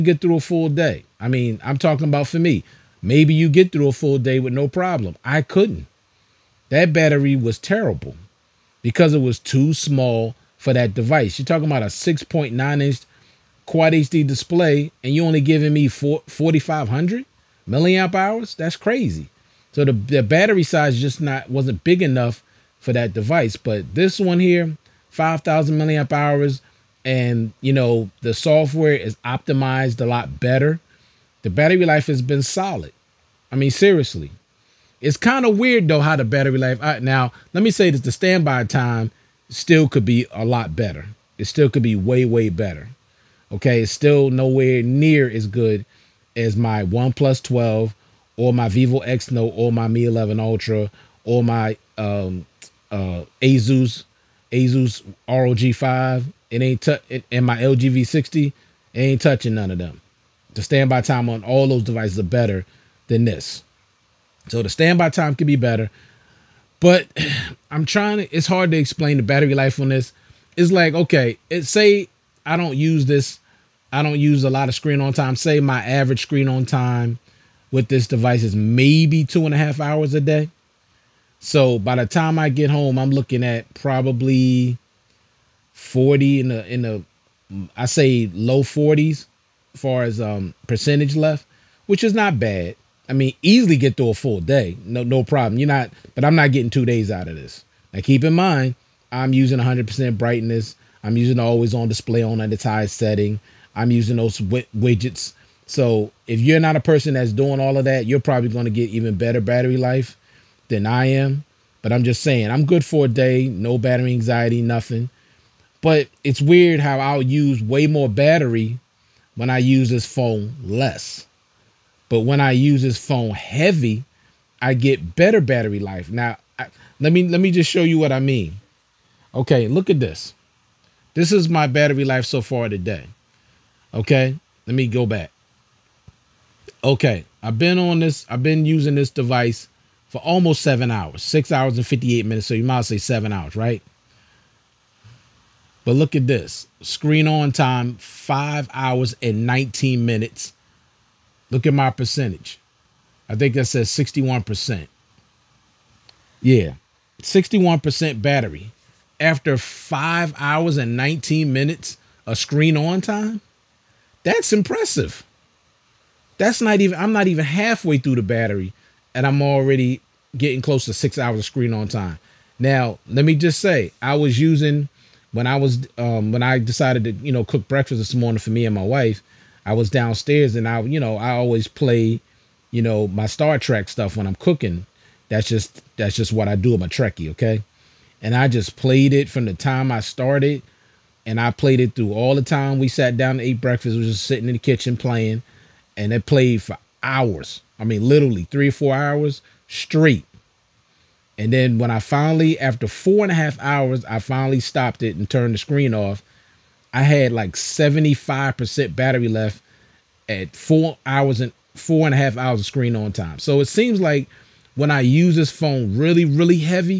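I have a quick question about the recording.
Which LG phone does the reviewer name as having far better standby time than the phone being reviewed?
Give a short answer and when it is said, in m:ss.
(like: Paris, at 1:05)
LG V60, at 0:57.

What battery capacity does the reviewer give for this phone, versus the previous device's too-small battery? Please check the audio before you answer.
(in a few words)
5,000 mAh.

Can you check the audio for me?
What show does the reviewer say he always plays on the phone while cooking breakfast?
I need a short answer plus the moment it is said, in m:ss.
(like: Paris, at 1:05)
Star Trek, at 3:03.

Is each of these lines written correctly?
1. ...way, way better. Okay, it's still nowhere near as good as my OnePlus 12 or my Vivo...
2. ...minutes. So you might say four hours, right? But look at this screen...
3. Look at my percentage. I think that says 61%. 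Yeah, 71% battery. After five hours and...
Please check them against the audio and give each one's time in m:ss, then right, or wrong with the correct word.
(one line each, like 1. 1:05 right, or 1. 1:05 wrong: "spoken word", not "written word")
1. 0:41 right
2. 2:22 wrong: "seven", not "four"
3. 2:31 wrong: "61", not "71".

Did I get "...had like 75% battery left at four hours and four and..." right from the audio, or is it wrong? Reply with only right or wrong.
right.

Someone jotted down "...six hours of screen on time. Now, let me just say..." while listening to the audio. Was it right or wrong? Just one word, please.
right.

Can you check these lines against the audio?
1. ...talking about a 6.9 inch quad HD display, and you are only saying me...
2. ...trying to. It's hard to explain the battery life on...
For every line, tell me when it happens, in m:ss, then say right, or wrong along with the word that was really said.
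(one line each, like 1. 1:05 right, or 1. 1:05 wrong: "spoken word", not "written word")
1. 0:11 wrong: "giving", not "saying"
2. 1:07 right.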